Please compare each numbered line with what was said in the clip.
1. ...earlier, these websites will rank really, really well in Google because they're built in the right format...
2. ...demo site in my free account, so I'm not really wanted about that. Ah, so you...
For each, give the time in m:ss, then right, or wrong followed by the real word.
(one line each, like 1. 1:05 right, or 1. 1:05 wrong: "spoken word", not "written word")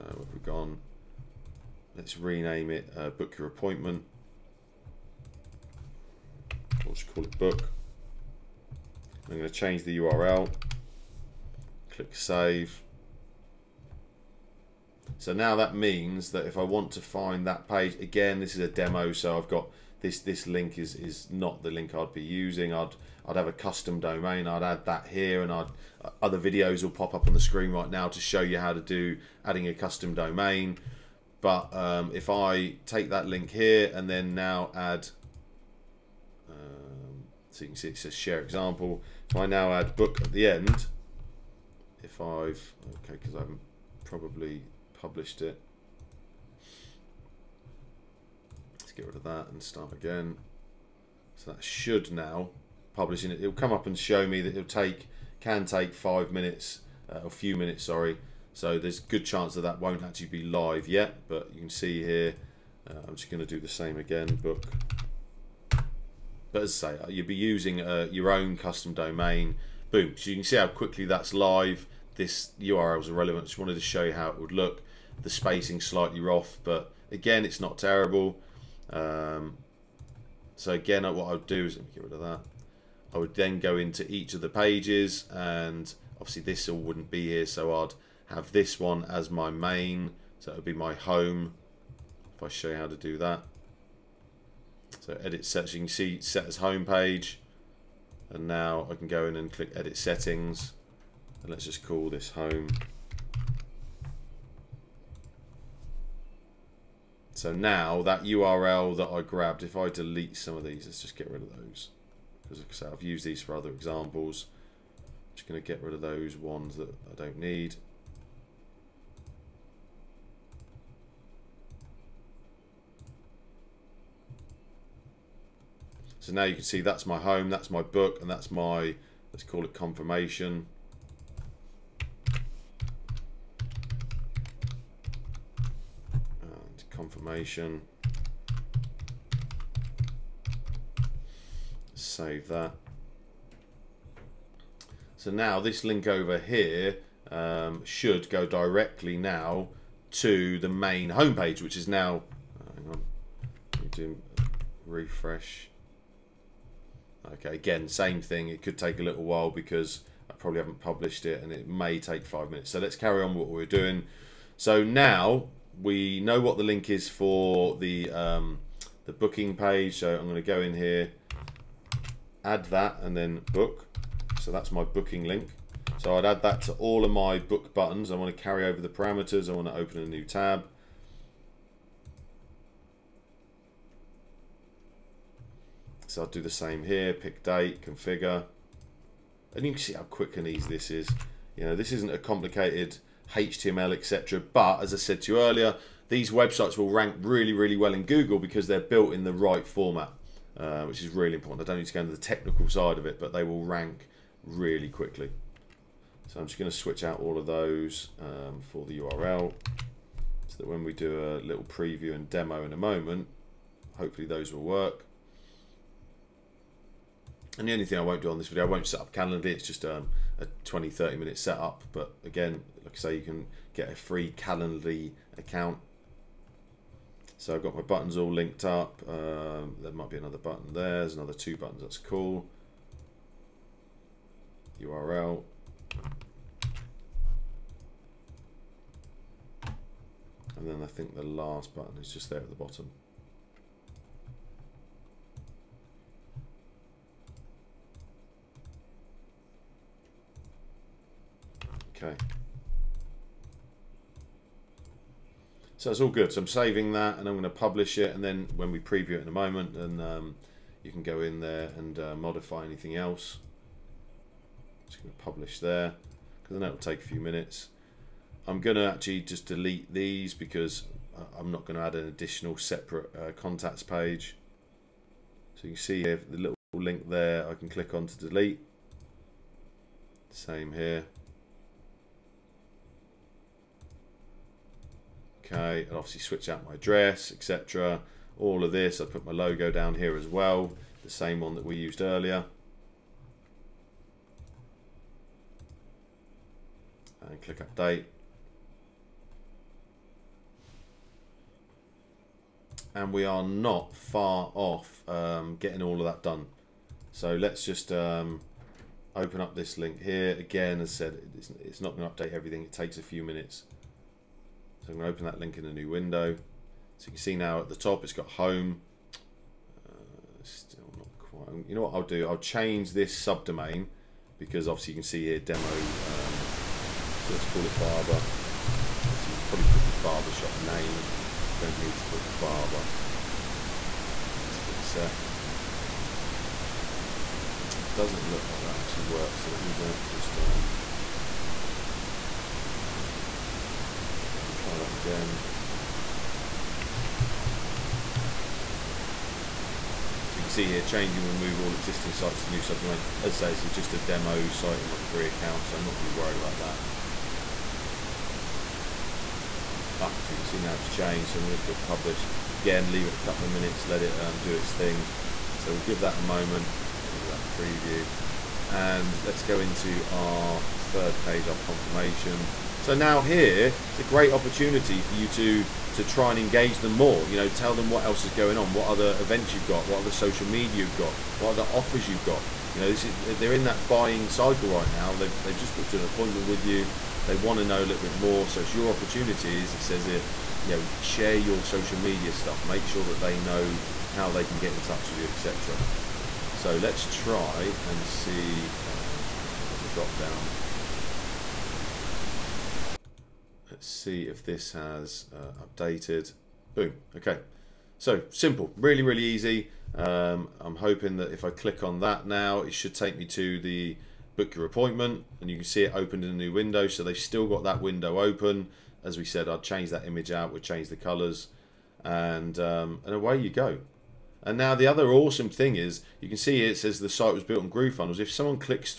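1. 3:15 right
2. 5:53 wrong: "worried", not "wanted".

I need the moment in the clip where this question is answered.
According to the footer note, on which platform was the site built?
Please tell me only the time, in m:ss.
7:07.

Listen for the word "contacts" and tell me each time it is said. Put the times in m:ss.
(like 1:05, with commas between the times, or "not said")
4:33.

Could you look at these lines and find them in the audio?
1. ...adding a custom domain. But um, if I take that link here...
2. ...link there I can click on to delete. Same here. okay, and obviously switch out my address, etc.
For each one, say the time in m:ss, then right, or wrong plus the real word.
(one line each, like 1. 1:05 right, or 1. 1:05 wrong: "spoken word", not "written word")
1. 0:29 right
2. 4:36 right.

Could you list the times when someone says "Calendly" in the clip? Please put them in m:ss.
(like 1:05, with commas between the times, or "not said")
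3:39, 3:44.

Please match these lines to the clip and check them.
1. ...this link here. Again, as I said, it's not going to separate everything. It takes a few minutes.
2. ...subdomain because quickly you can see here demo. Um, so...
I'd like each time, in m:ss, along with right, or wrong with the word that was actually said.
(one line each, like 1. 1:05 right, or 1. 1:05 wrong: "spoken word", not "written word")
1. 5:09 wrong: "update", not "separate"
2. 5:23 wrong: "obviously", not "quickly".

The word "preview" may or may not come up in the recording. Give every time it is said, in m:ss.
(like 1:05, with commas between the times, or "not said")
3:31, 4:18, 6:07.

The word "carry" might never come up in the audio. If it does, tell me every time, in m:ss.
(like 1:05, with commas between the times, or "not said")
2:42, 2:58.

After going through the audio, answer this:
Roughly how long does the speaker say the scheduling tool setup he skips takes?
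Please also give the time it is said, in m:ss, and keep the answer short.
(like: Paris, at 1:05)
20 to 30 minutes, at 3:40.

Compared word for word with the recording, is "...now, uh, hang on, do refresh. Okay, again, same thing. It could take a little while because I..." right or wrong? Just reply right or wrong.
right.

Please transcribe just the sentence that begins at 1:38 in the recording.
And now I can go in and click edit settings.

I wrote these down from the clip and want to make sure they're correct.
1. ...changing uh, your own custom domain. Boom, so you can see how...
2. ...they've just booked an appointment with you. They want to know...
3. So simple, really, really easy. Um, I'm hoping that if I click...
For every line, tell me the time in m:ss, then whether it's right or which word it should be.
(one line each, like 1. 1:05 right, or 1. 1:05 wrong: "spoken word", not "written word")
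1. 1:07 wrong: "using", not "changing"
2. 6:25 right
3. 6:47 right.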